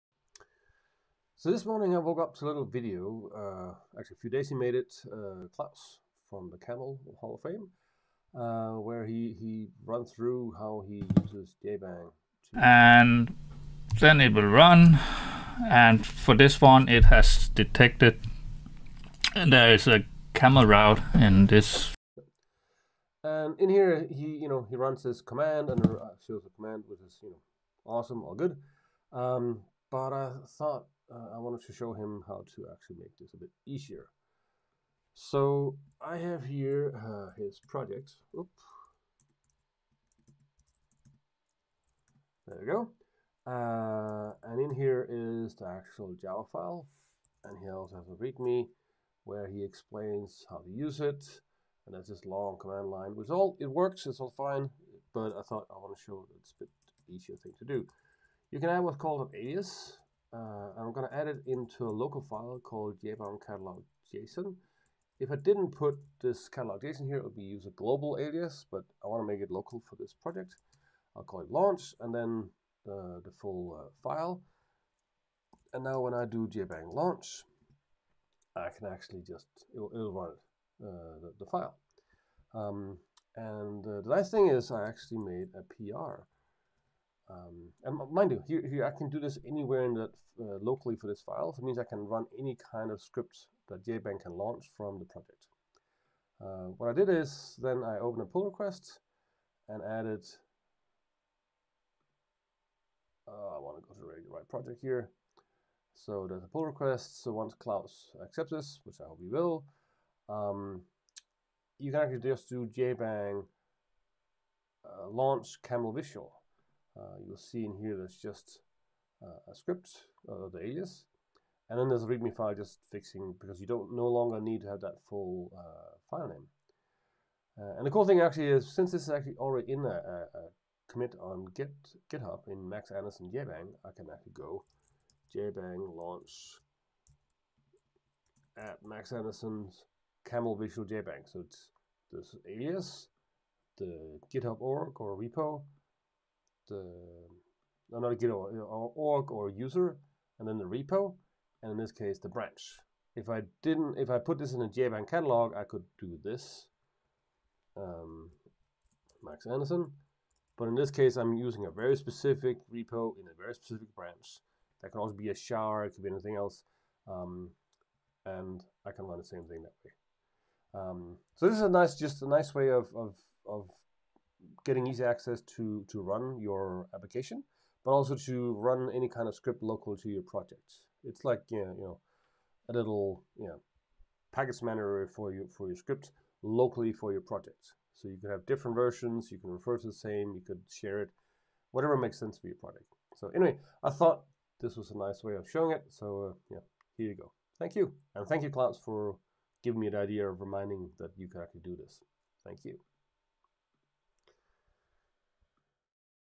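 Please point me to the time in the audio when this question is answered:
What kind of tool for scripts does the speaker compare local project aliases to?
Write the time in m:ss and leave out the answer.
3:04.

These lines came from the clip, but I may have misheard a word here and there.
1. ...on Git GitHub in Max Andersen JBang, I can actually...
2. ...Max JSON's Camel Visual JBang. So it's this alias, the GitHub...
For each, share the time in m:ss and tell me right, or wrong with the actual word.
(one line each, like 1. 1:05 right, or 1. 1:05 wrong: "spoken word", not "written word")
1. 2:11 right
2. 2:18 wrong: "Andersen", not "JSON".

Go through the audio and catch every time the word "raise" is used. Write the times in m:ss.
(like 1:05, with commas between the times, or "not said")
not said.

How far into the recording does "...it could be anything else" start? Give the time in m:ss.
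2:45.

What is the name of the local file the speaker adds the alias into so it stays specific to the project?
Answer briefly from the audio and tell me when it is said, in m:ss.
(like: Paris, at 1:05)
jbang catalog JSON, at 1:03.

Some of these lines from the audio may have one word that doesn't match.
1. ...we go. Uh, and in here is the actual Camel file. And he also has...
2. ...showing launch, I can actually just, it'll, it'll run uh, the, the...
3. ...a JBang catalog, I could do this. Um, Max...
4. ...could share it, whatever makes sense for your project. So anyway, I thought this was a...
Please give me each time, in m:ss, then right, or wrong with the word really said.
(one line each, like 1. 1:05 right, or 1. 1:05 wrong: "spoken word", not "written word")
1. 0:42 wrong: "Java", not "Camel"
2. 1:16 wrong: "jbang", not "showing"
3. 2:34 right
4. 3:10 right.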